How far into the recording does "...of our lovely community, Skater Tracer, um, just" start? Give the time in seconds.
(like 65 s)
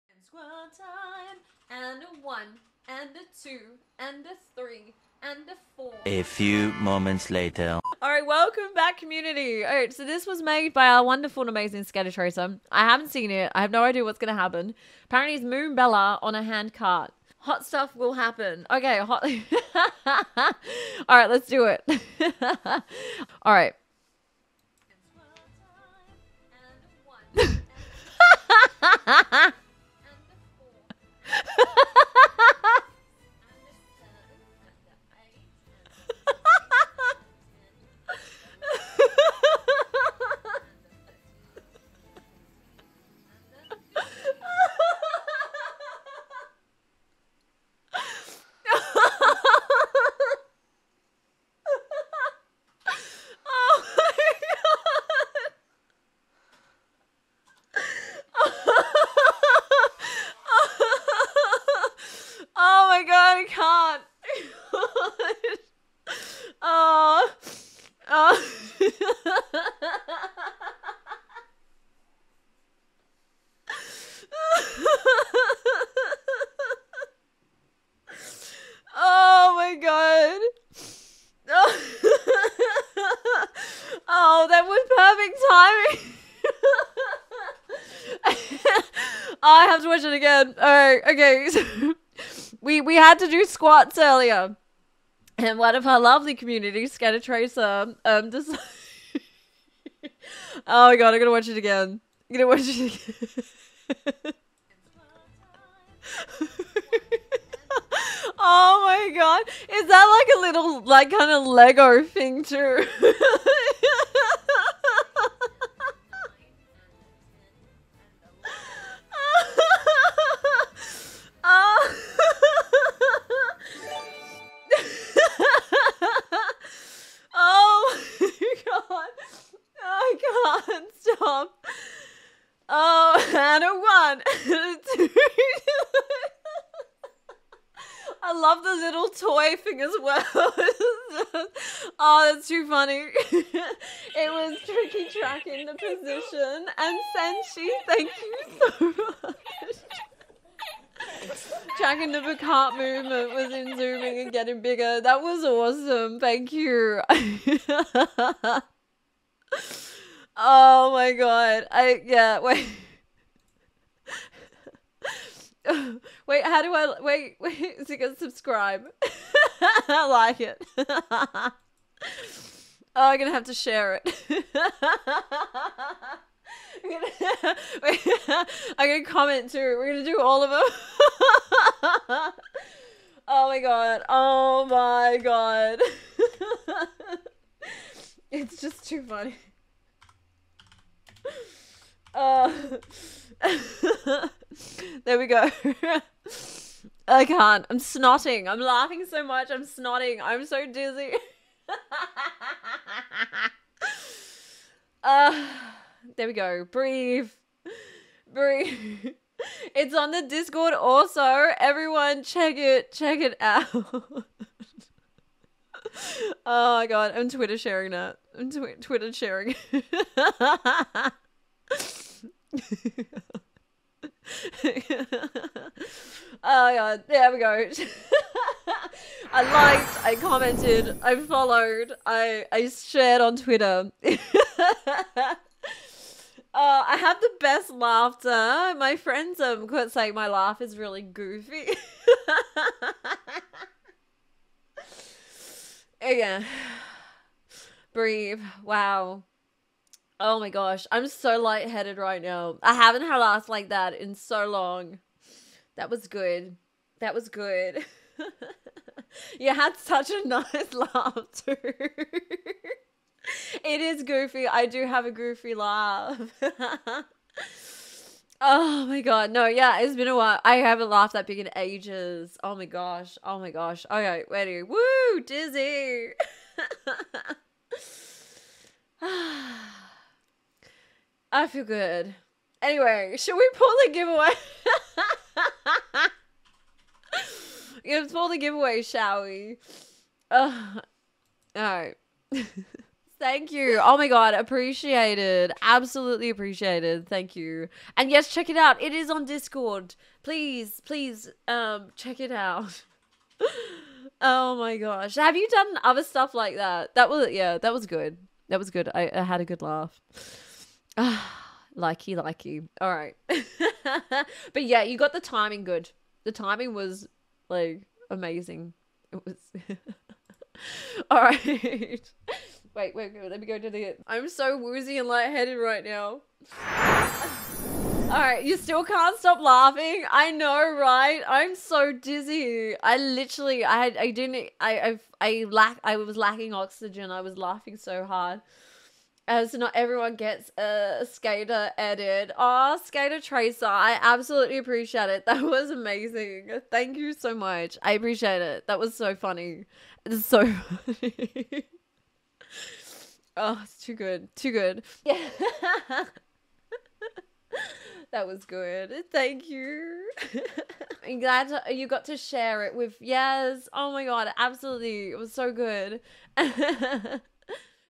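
95 s.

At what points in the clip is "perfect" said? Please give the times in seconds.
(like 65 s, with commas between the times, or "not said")
85 s.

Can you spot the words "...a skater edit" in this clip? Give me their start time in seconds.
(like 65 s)
340 s.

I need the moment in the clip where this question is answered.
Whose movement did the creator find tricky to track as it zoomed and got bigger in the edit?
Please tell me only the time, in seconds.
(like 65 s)
152 s.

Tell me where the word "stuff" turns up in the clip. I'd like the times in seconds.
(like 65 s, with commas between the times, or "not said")
17 s, 306 s.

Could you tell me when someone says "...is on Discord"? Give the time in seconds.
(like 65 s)
298 s.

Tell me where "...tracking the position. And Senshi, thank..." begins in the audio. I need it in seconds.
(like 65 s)
145 s.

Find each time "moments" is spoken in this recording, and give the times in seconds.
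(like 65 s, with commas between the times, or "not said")
6 s.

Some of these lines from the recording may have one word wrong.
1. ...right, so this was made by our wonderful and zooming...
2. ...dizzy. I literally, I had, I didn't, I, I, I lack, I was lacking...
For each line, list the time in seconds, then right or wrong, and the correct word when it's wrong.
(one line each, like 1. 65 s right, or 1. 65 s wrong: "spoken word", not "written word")
1. 9 s wrong: "amazing", not "zooming"
2. 331 s right.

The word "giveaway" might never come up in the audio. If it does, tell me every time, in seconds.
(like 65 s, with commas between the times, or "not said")
283 s, 288 s.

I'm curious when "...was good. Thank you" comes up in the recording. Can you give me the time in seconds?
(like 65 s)
358 s.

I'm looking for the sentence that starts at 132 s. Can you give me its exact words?
Oh, and a one, and a I love the little toy thing as well.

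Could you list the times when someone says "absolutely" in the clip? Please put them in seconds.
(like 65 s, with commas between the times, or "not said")
295 s, 344 s, 364 s.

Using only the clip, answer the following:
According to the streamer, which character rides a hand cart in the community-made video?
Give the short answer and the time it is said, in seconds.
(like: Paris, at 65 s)
Moonbella, at 15 s.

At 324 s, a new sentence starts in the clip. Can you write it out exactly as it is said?
I'm so woozy and lightheaded right now.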